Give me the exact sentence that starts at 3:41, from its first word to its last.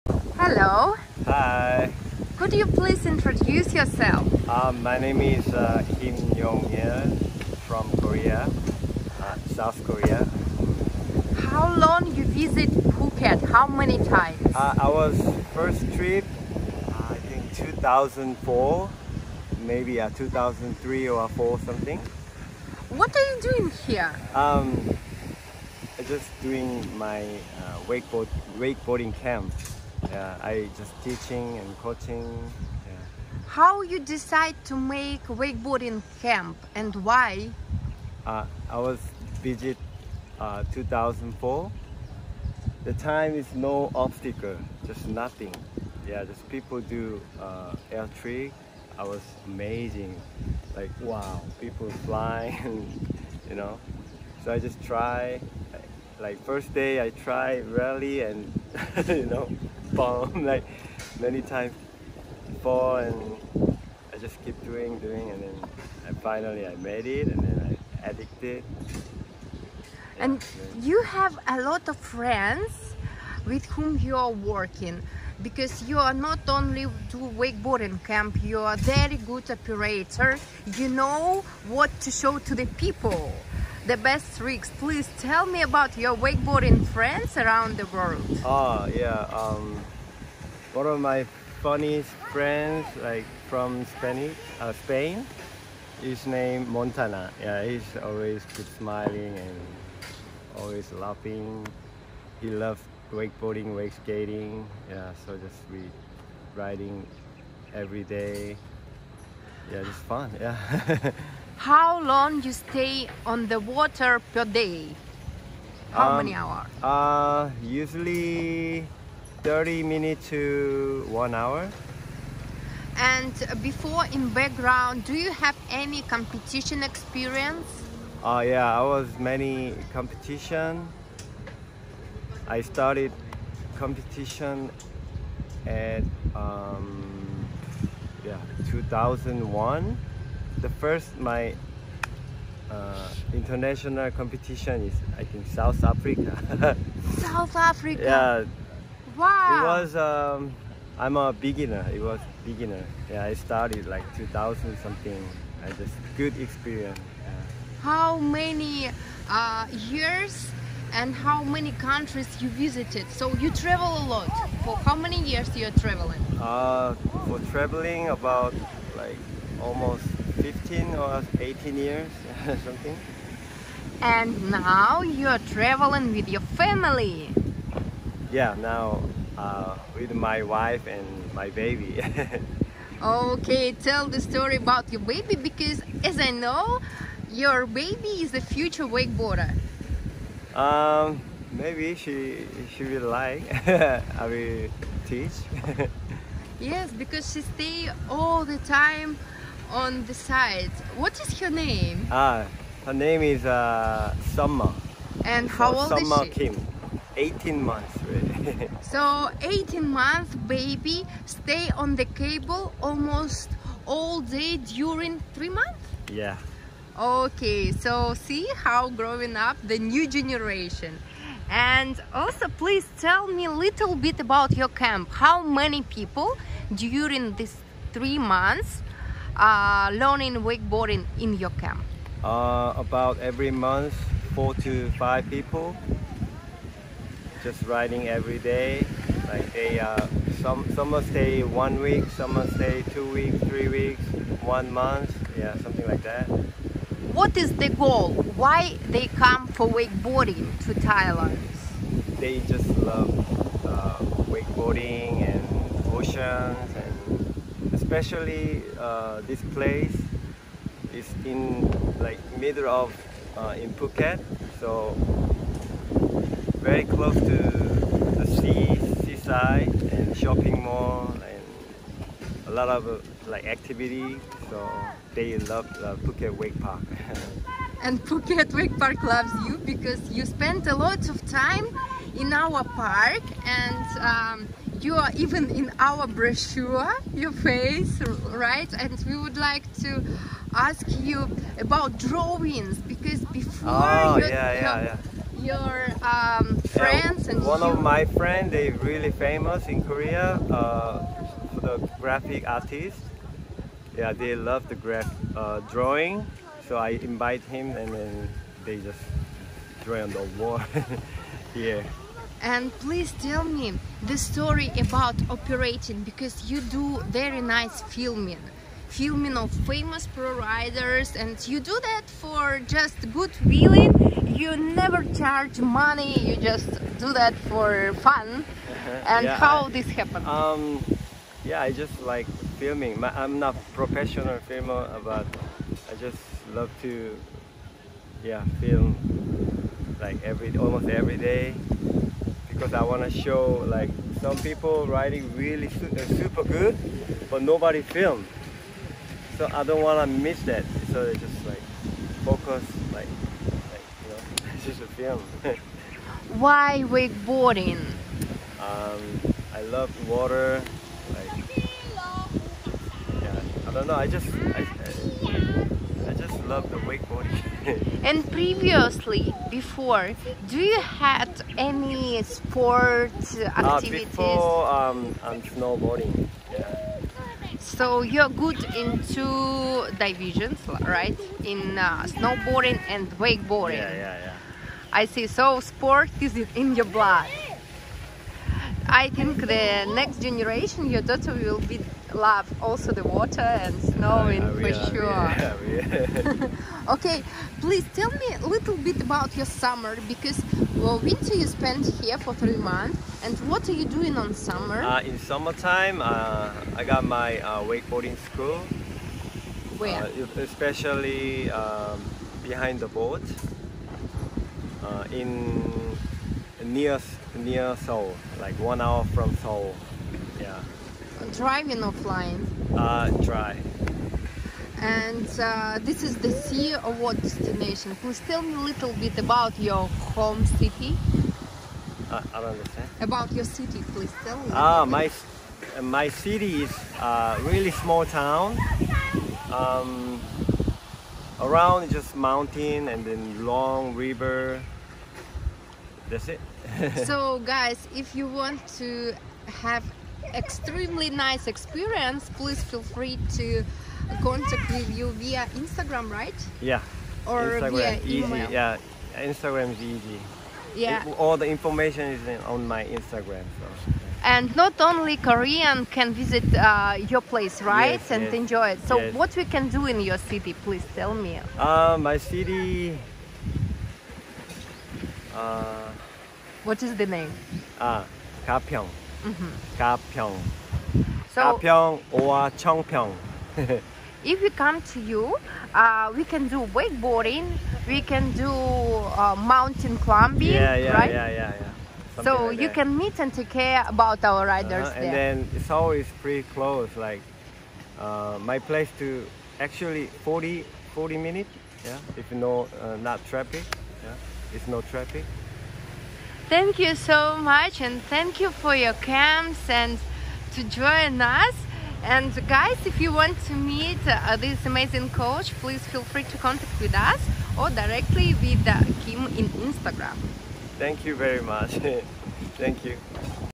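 And also please tell me a little bit about your camp.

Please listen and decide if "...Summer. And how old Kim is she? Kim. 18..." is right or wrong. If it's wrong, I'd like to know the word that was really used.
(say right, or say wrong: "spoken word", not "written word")
wrong: "Summer", not "Kim".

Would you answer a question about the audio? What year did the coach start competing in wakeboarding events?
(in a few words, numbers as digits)
2001.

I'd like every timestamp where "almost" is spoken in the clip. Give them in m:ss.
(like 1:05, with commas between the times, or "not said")
2:49, 3:32, 5:40.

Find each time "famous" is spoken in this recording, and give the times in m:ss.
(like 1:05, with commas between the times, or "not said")
4:59, 5:19.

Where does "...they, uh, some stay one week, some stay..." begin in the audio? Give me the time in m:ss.
3:59.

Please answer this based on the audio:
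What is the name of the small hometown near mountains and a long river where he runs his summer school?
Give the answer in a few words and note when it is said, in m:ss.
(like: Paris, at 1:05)
Gapyeong, at 7:58.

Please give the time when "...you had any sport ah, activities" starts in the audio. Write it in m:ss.
6:10.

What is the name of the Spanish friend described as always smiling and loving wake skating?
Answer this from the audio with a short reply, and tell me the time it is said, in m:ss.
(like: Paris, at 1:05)
Montana, at 1:36.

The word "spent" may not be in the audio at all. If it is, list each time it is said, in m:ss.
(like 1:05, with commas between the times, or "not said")
4:40, 6:41.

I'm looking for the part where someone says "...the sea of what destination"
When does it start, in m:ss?
7:06.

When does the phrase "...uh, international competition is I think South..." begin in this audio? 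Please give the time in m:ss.
2:22.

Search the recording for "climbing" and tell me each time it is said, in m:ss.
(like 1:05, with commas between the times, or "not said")
8:09.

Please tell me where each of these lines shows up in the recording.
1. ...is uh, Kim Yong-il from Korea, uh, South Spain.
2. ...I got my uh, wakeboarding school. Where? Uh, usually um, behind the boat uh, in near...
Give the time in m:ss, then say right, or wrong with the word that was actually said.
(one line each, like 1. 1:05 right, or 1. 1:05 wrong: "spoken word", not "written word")
1. 0:05 wrong: "Korea", not "Spain"
2. 6:46 wrong: "especially", not "usually".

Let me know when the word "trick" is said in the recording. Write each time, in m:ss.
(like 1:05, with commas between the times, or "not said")
0:48, 1:24.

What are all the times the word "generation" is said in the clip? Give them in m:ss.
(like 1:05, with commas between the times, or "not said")
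3:40, 6:30.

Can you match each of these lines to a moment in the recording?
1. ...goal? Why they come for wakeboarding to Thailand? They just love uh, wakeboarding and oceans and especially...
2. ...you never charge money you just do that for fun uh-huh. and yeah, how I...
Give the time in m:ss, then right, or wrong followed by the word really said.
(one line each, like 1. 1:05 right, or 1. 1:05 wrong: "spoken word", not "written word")
1. 4:07 right
2. 5:24 right.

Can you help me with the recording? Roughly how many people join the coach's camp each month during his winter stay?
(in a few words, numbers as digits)
4 to 5.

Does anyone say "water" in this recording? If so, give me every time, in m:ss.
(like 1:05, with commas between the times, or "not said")
1:53, 6:00, 6:33.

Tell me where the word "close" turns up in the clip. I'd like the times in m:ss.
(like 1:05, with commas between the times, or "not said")
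4:26, 8:16.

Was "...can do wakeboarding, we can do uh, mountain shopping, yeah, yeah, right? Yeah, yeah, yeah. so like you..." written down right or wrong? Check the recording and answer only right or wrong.
wrong.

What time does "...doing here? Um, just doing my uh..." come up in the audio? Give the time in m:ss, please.
0:23.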